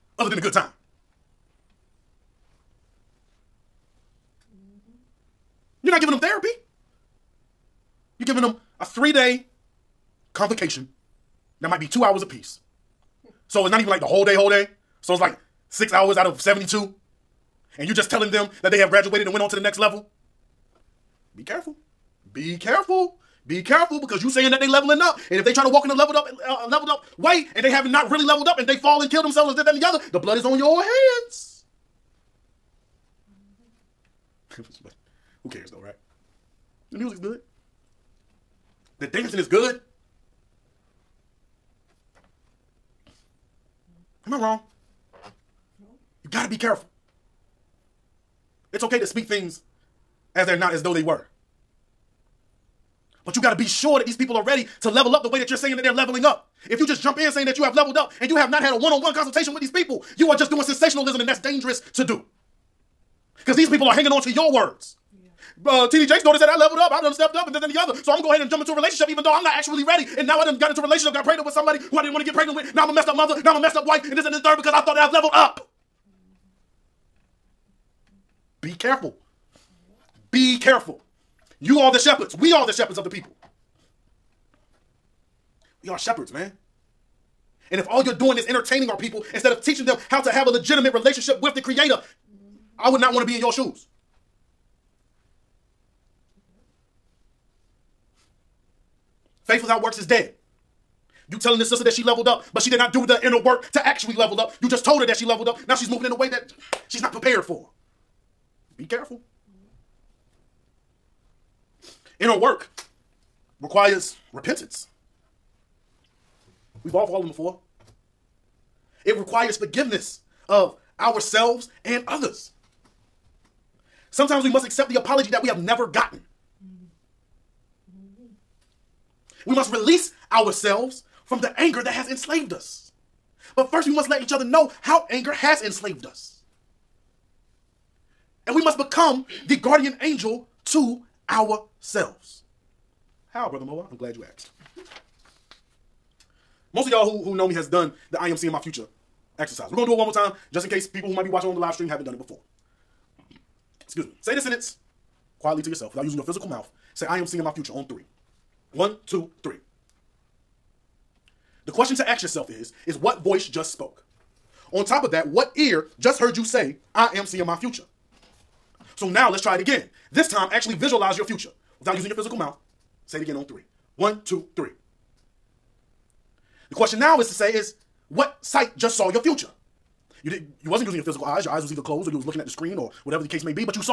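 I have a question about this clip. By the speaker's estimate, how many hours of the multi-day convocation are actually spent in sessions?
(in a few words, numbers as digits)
6.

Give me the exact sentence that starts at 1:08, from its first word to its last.
So I'm going to go ahead and jump into a relationship even though I'm not actually ready.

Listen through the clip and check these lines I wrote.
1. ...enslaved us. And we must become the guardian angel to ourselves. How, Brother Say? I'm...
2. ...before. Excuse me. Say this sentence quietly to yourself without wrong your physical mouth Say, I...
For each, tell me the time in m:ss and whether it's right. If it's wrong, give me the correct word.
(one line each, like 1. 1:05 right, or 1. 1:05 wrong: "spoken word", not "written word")
1. 2:15 wrong: "Mowa", not "Say"
2. 2:32 wrong: "using", not "wrong".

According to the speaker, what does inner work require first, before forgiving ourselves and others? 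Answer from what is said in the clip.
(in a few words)
Repentance.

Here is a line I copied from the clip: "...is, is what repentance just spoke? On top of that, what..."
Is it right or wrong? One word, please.
wrong.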